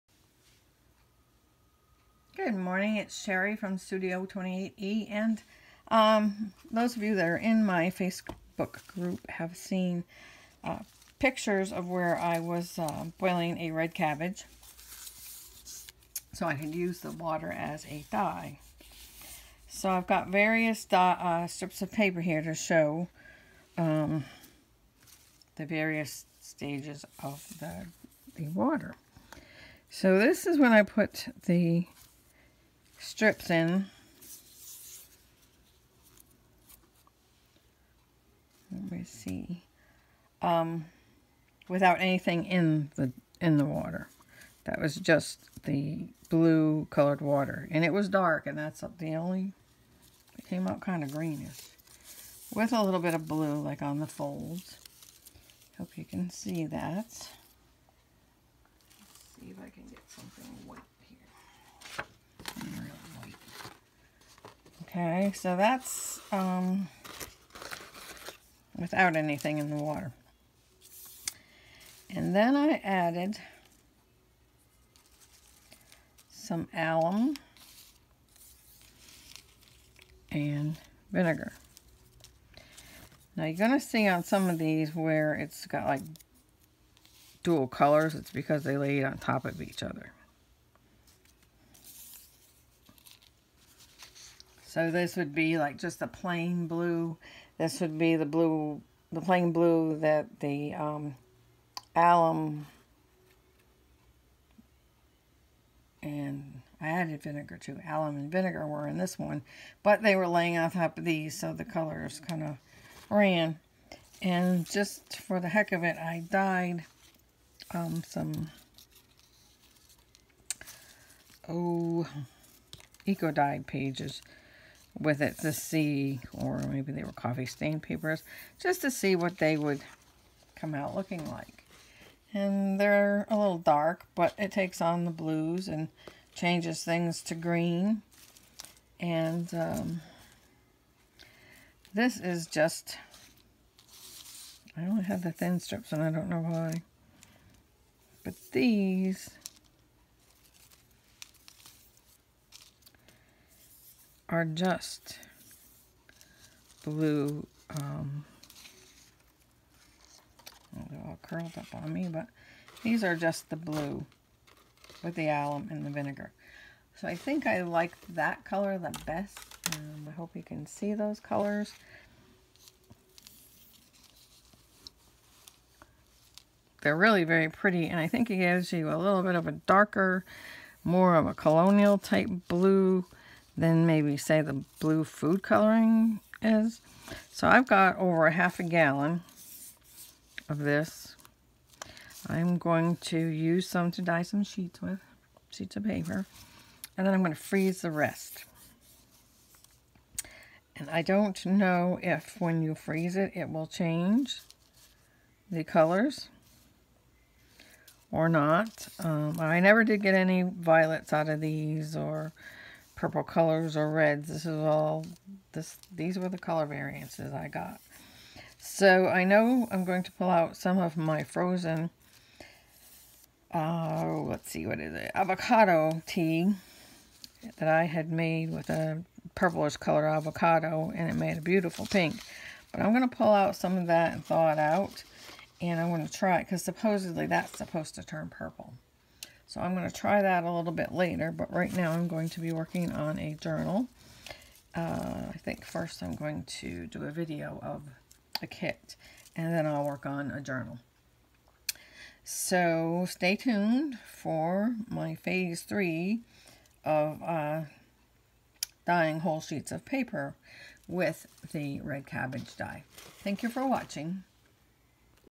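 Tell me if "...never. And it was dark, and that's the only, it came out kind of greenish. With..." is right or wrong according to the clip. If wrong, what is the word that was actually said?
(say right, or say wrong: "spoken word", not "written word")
wrong: "water", not "never".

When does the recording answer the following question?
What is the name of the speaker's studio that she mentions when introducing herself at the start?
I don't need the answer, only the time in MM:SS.
00:03.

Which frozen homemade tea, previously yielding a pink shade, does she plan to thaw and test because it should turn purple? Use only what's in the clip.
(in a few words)
Avocado tea.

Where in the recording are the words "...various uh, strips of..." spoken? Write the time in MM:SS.
00:20.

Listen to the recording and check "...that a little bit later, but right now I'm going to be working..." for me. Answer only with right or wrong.
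right.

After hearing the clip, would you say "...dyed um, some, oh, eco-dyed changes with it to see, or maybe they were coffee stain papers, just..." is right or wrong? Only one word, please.
wrong.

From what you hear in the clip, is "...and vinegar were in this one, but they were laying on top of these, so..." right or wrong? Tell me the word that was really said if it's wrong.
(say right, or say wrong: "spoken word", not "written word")
right.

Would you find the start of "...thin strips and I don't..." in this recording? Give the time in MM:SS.
02:25.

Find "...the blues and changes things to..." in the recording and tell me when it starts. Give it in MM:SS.
02:15.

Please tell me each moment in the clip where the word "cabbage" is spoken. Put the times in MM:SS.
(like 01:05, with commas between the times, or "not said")
00:13, 04:22.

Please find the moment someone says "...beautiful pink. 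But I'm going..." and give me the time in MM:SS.
03:51.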